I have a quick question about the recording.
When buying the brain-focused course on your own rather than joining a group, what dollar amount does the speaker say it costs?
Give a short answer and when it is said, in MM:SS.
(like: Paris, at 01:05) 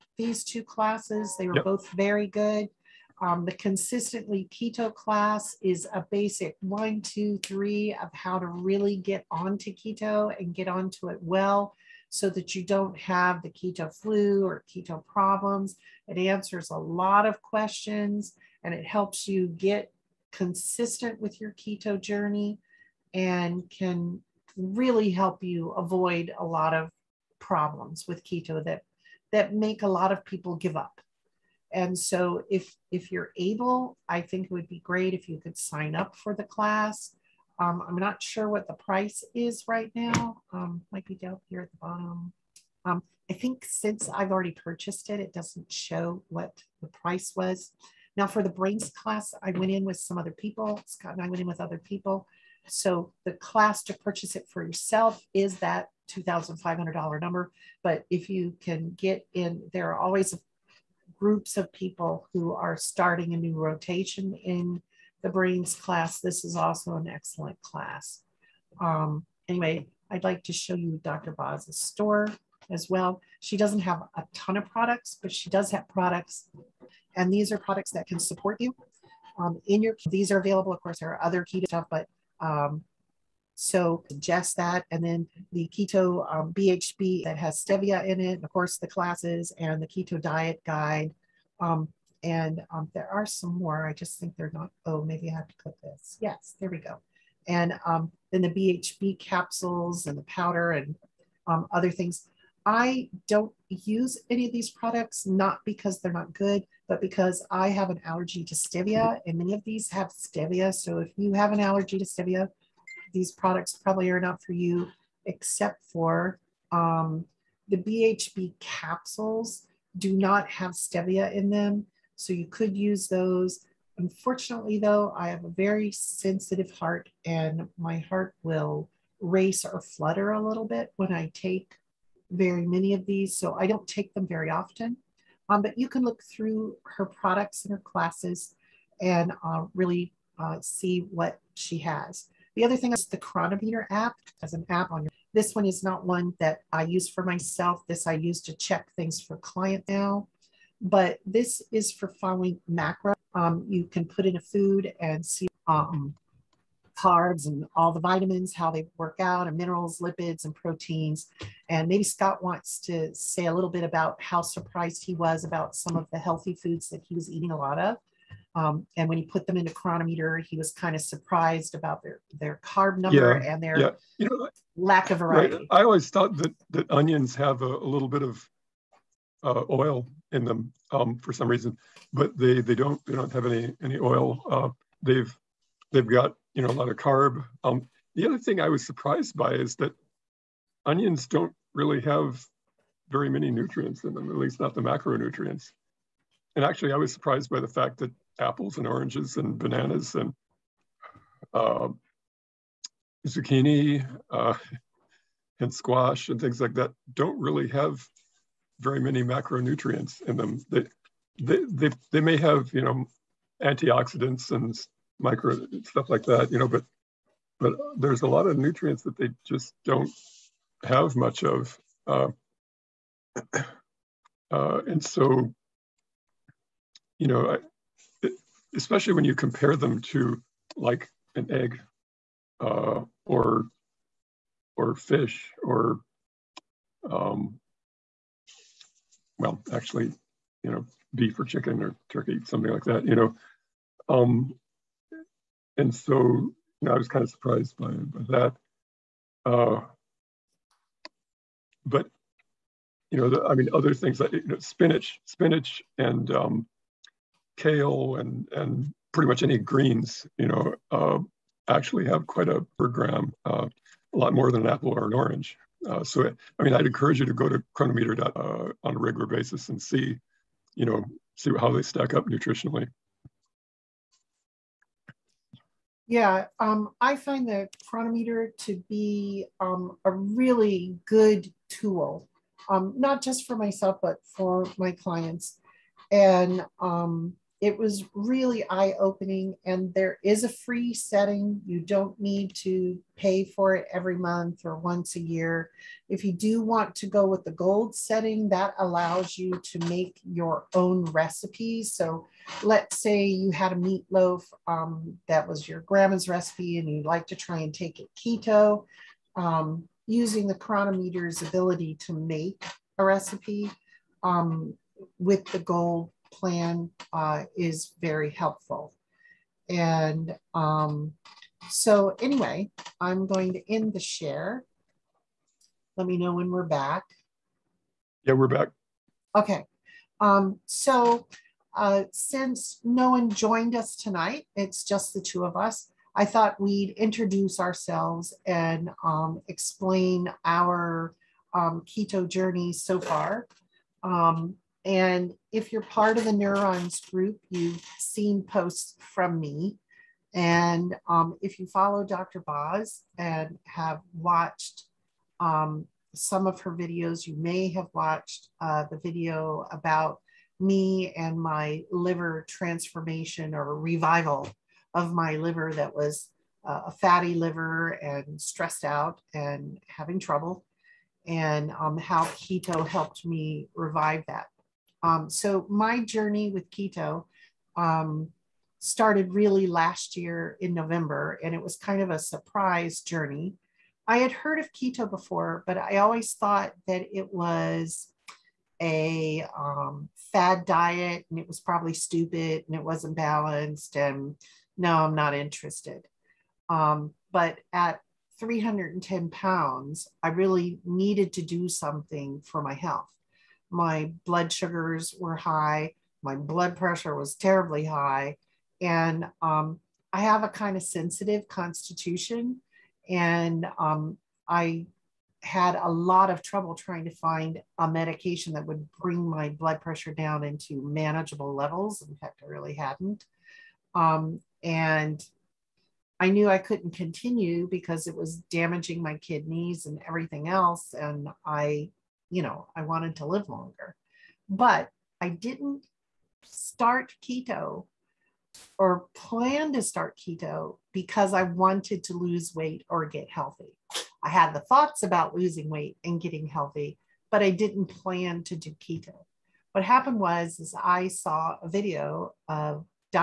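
$2,500, at 00:56.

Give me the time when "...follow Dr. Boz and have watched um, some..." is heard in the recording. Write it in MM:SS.
05:51.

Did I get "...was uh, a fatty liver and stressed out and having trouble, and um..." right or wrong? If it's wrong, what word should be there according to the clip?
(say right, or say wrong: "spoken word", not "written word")
right.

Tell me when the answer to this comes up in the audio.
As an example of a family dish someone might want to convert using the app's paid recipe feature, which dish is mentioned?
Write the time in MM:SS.
05:03.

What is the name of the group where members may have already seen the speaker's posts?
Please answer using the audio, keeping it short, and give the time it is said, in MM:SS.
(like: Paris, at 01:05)
Neurons group, at 05:46.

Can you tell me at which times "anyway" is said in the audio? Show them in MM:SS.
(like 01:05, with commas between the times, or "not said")
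01:09, 05:22.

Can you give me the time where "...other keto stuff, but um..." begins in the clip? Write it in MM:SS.
01:21.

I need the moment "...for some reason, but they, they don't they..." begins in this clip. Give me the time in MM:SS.
03:01.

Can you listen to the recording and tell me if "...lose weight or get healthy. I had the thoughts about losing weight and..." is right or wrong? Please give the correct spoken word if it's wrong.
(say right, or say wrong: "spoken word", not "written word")
right.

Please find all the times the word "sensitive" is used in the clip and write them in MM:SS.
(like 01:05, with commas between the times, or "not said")
02:05, 06:50.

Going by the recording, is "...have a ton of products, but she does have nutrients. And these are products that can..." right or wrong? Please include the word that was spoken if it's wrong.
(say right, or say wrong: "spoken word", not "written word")
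wrong: "products", not "nutrients".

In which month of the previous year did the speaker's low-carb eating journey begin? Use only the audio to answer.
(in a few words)
November.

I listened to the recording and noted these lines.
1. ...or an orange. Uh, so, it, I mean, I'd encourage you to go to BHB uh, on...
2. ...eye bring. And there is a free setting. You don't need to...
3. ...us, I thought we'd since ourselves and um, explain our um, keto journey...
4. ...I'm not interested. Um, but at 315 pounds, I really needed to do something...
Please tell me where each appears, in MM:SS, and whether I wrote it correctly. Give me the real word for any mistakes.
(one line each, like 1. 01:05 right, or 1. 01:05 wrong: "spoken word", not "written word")
1. 04:24 wrong: "Cronometer", not "BHB"
2. 04:48 wrong: "opening", not "bring"
3. 05:35 wrong: "introduce", not "since"
4. 06:34 wrong: "310", not "315".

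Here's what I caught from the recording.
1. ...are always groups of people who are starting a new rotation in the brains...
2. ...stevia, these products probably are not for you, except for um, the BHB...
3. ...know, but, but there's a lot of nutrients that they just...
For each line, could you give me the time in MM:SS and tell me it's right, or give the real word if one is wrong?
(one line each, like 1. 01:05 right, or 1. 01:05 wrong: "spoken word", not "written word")
1. 00:59 right
2. 01:52 right
3. 03:36 right.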